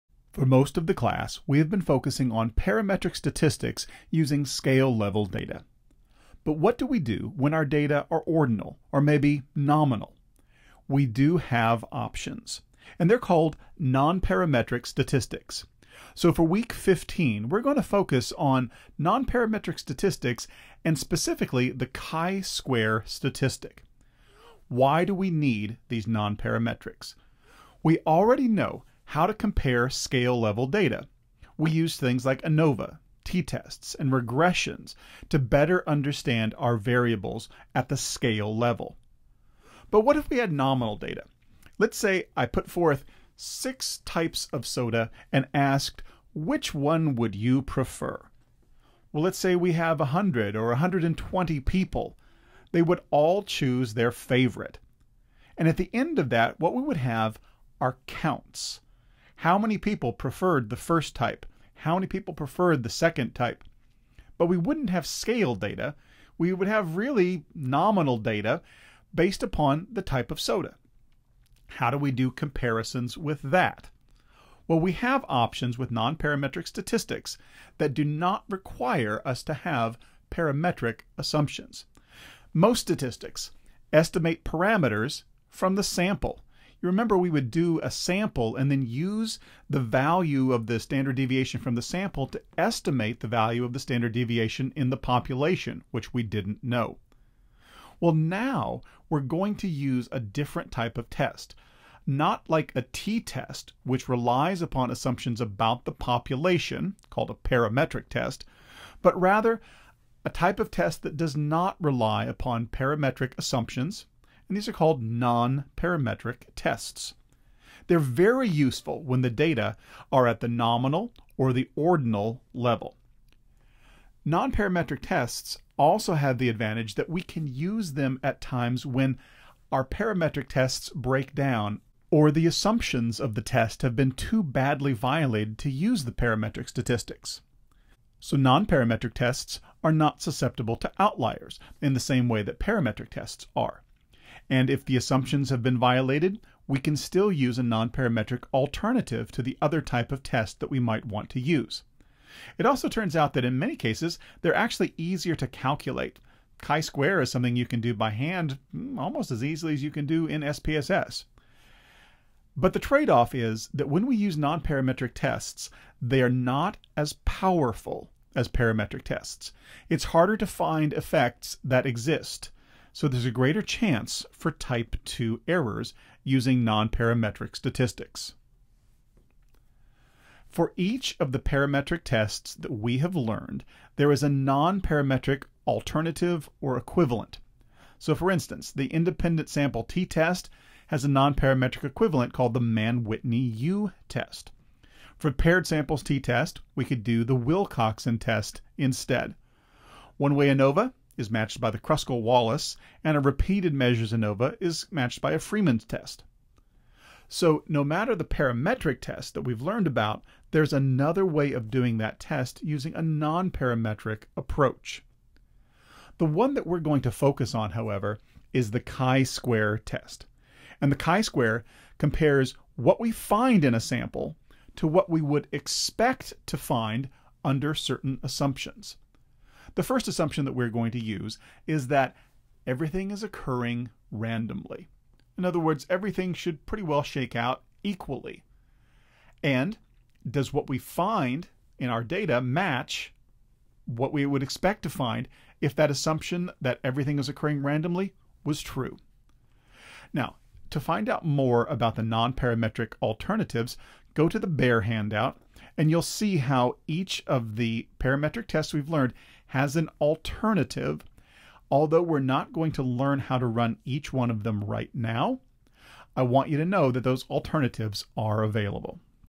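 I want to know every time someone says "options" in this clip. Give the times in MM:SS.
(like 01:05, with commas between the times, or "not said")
00:11, 01:15.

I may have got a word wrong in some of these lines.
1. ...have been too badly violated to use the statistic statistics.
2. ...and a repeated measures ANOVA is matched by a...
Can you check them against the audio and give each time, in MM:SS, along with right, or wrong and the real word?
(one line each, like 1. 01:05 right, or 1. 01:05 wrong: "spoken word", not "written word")
1. 02:13 wrong: "parametric", not "statistic"
2. 03:23 right.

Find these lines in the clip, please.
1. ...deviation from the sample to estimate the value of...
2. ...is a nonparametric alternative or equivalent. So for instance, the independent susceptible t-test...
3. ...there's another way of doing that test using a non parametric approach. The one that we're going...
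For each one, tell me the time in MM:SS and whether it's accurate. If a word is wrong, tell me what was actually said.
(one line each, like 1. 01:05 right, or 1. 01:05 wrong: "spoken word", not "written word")
1. 01:31 right
2. 03:04 wrong: "sample", not "susceptible"
3. 03:30 right.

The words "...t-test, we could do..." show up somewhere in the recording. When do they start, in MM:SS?
03:16.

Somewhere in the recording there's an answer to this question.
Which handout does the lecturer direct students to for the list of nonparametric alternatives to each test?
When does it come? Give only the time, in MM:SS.
04:14.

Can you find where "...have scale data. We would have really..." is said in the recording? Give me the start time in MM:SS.
01:04.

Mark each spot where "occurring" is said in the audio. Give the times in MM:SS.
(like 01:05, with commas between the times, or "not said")
03:53, 04:07.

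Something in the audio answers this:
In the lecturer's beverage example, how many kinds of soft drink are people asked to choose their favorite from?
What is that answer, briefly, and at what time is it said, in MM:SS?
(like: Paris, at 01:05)
6, at 00:43.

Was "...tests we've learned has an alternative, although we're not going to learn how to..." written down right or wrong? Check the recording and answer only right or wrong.
right.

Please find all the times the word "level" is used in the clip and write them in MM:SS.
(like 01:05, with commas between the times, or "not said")
00:04, 00:30, 00:38, 02:02.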